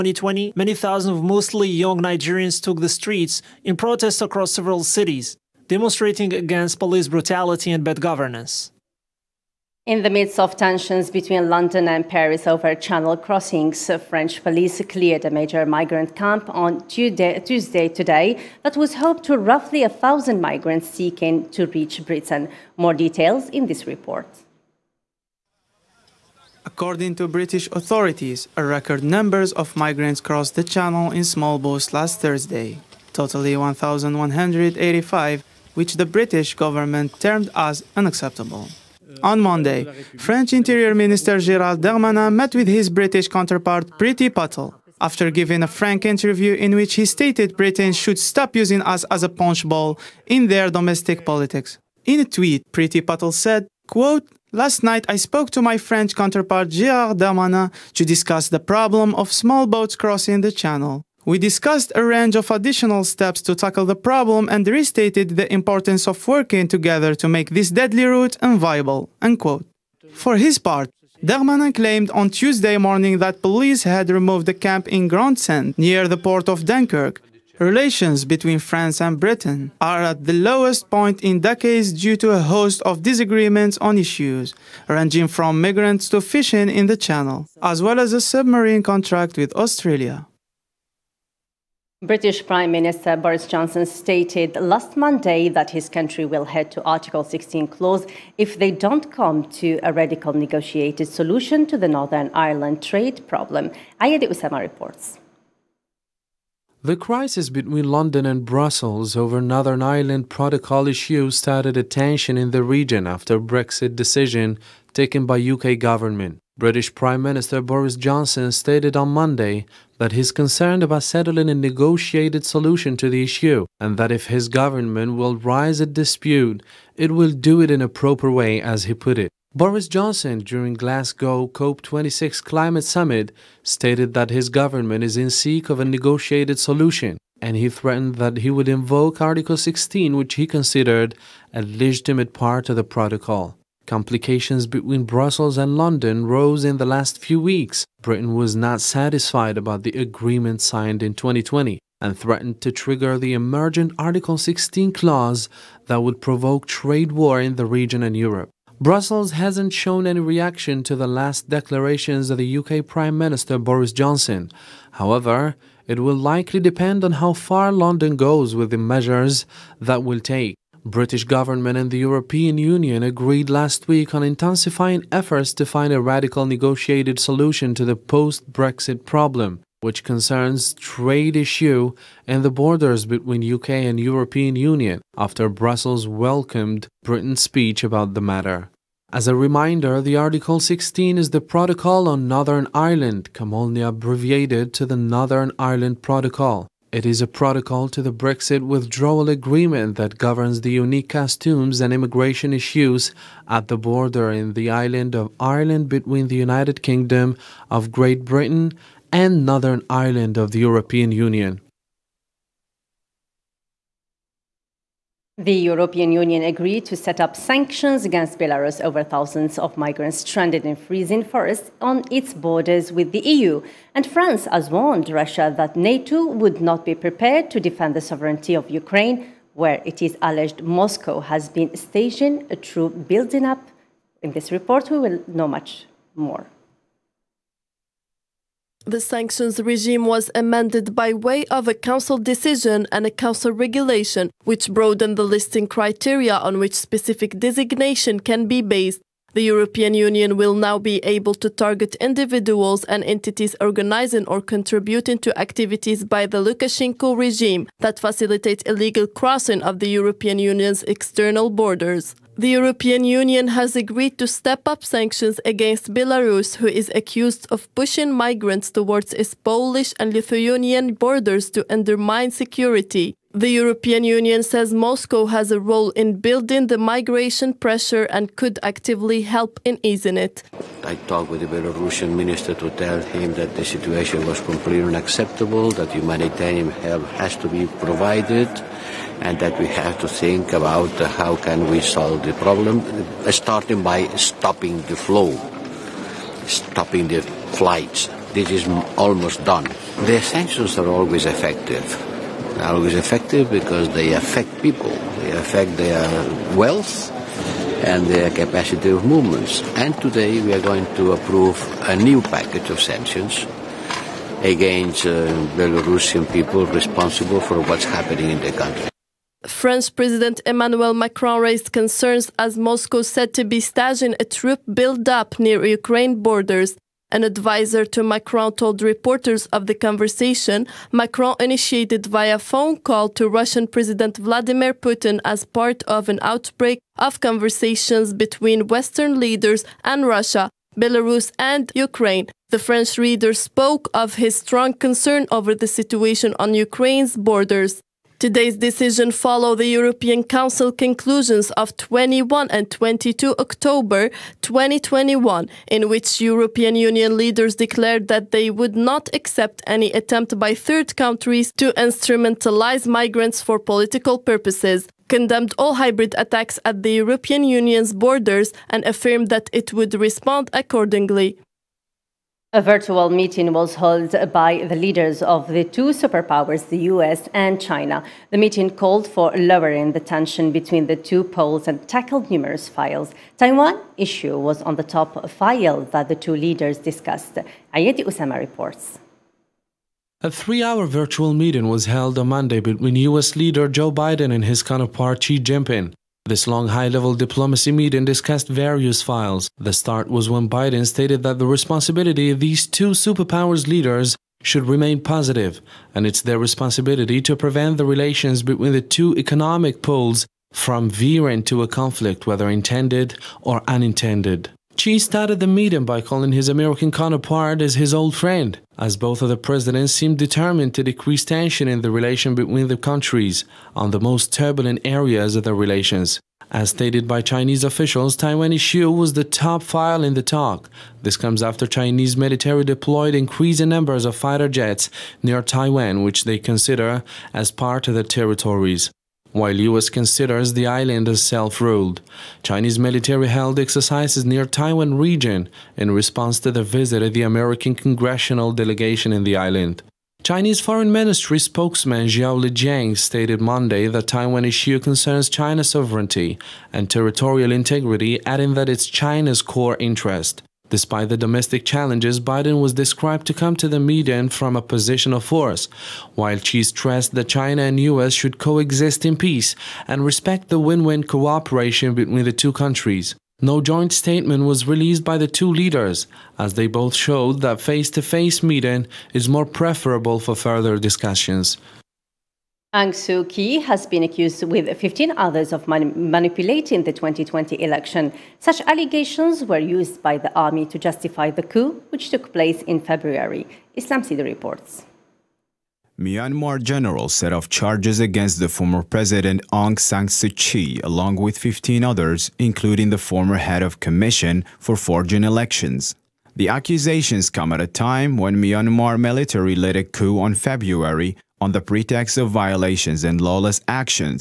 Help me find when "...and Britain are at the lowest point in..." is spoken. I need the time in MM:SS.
01:19.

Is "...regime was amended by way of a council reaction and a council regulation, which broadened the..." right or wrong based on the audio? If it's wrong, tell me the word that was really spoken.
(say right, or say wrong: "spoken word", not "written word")
wrong: "decision", not "reaction".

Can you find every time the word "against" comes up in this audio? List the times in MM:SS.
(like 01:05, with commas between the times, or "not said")
00:06, 03:38, 04:25, 05:14, 08:17.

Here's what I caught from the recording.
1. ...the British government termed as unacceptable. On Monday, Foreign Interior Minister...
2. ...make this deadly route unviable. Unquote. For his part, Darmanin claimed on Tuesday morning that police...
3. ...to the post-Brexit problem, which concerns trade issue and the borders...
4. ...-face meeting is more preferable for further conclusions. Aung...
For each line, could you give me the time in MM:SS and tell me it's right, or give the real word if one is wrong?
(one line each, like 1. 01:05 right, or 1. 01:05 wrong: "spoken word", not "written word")
1. 00:35 wrong: "French", not "Foreign"
2. 01:07 right
3. 02:57 right
4. 07:58 wrong: "discussions", not "conclusions".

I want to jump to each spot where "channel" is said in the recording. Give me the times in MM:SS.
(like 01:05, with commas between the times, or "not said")
00:12, 00:30, 01:00, 01:26.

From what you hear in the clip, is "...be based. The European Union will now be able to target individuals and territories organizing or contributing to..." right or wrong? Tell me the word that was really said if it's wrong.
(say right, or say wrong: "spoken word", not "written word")
wrong: "entities", not "territories".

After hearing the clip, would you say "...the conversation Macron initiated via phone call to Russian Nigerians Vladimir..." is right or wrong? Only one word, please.
wrong.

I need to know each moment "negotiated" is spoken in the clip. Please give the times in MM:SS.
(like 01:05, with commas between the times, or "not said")
01:40, 02:01, 02:15, 02:56.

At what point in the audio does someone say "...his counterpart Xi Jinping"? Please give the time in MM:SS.
06:34.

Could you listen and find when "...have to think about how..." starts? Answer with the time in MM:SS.
04:49.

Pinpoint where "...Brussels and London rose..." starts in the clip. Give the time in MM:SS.
02:25.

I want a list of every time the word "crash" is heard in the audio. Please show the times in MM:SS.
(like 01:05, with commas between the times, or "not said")
not said.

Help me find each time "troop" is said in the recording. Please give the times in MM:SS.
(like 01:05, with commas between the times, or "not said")
03:52, 05:24.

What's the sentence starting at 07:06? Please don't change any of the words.
As stated by Chinese officials, Taiwan issue was the top file in the talk.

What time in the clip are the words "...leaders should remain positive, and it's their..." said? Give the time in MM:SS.
06:43.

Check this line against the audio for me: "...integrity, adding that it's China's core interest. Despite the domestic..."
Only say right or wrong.
right.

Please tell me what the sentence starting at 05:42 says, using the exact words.
The French leader spoke of his strong concern over the situation on Ukraine's borders.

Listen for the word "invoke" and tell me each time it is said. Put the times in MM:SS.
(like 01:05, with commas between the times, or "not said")
02:18.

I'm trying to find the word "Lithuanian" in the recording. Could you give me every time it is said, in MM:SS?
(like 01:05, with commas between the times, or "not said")
04:30.